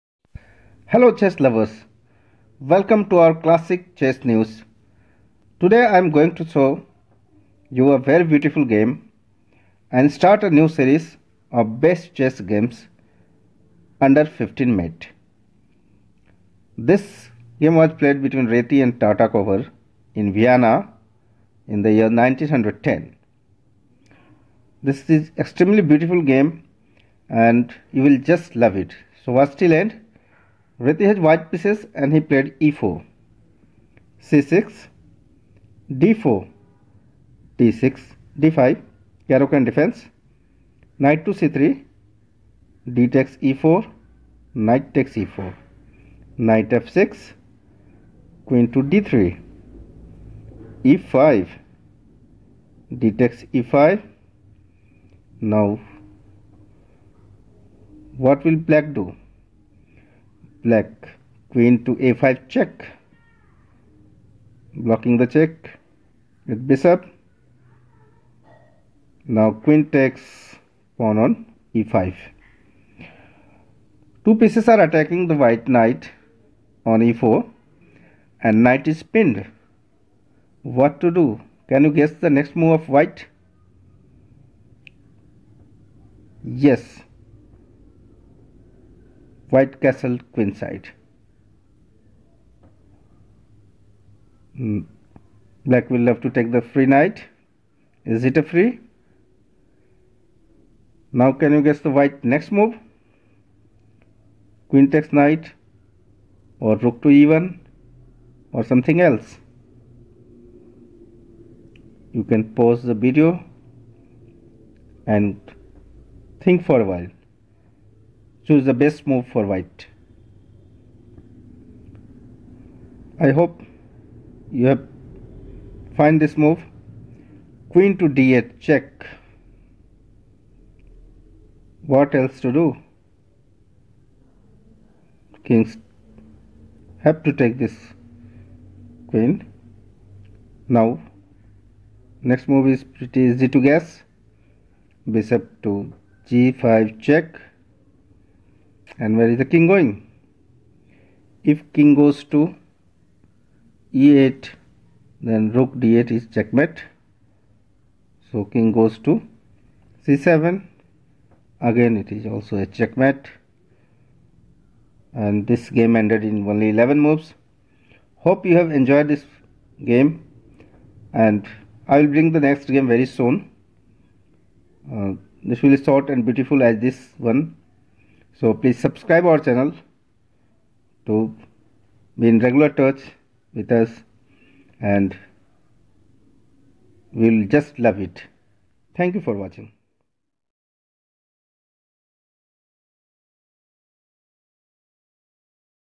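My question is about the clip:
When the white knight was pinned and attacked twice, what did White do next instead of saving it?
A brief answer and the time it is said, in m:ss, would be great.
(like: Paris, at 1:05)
Castle queenside, at 1:29.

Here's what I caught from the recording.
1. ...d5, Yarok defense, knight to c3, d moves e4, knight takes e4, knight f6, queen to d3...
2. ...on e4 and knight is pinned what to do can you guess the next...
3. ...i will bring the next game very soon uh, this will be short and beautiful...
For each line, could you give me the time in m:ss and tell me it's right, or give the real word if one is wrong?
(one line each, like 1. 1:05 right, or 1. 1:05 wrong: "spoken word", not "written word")
1. 0:38 wrong: "takes", not "moves"
2. 1:16 right
3. 2:51 right.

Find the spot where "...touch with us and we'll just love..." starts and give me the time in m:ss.
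3:02.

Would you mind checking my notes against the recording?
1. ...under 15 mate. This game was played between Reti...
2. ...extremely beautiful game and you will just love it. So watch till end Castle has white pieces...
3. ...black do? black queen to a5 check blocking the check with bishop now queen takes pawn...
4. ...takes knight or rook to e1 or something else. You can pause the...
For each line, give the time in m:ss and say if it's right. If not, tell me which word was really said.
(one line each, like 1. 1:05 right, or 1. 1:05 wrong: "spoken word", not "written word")
1. 0:14 right
2. 0:25 wrong: "Reti", not "Castle"
3. 0:58 right
4. 1:44 right.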